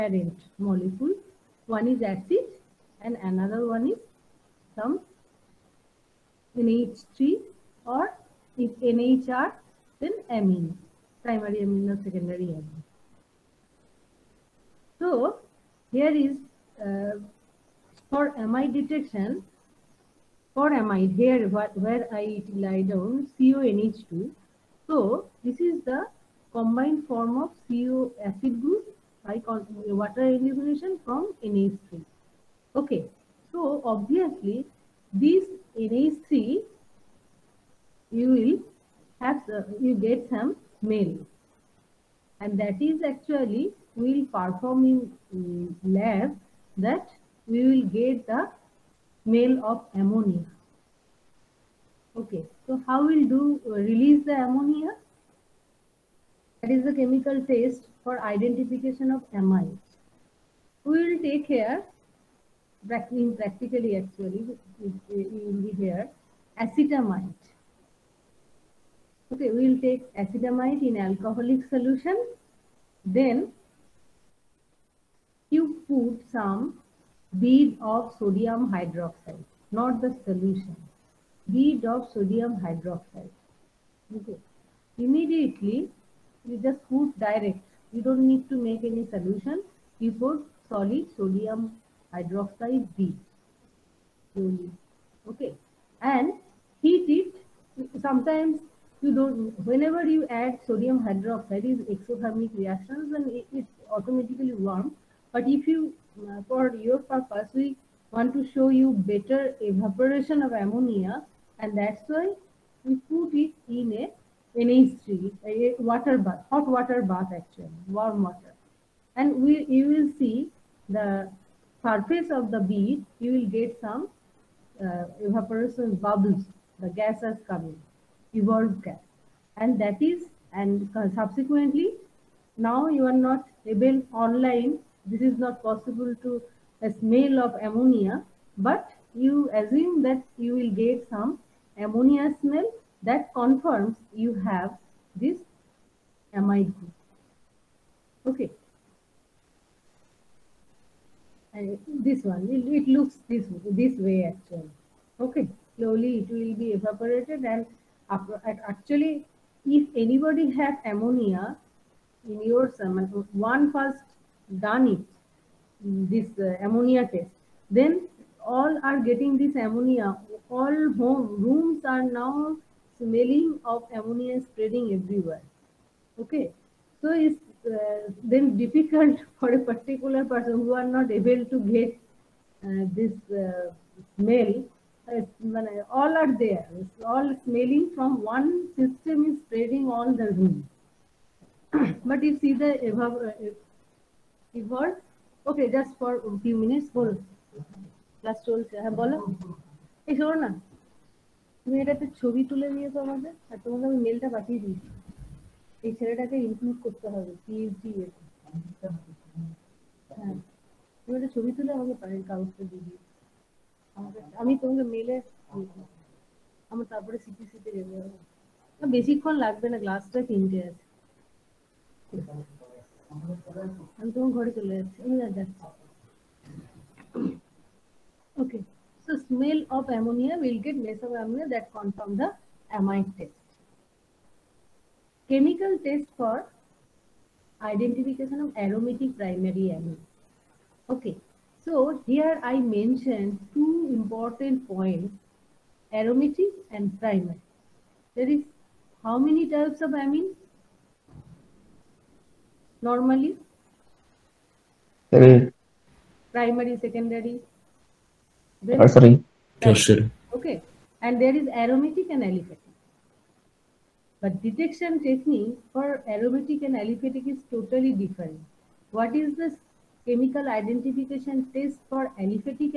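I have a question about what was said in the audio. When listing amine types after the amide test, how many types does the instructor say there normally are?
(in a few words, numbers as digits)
3.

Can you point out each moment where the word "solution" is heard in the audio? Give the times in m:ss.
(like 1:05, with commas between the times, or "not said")
1:11, 1:20, 1:29.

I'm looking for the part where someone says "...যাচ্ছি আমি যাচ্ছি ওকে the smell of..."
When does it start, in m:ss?
3:44.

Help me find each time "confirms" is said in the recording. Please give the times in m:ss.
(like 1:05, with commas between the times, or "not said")
2:23, 3:51.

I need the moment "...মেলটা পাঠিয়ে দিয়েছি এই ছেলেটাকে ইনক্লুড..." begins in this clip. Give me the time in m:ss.
3:24.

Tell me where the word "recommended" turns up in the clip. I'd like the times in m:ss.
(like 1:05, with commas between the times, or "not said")
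not said.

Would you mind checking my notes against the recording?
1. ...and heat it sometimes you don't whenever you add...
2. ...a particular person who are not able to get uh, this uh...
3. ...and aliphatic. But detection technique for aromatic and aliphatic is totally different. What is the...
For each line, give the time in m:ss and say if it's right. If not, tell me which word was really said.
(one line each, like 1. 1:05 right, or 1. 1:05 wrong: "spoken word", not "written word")
1. 1:36 right
2. 2:59 right
3. 4:22 right.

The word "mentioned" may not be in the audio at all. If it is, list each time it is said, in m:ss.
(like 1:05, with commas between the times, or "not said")
4:02.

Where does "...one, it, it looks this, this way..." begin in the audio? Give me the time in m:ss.
2:32.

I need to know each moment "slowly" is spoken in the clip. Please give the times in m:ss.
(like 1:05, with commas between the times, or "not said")
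1:34, 2:35.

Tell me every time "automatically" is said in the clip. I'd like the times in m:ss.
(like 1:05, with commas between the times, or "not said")
1:43.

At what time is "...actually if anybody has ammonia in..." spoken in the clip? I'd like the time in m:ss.
2:38.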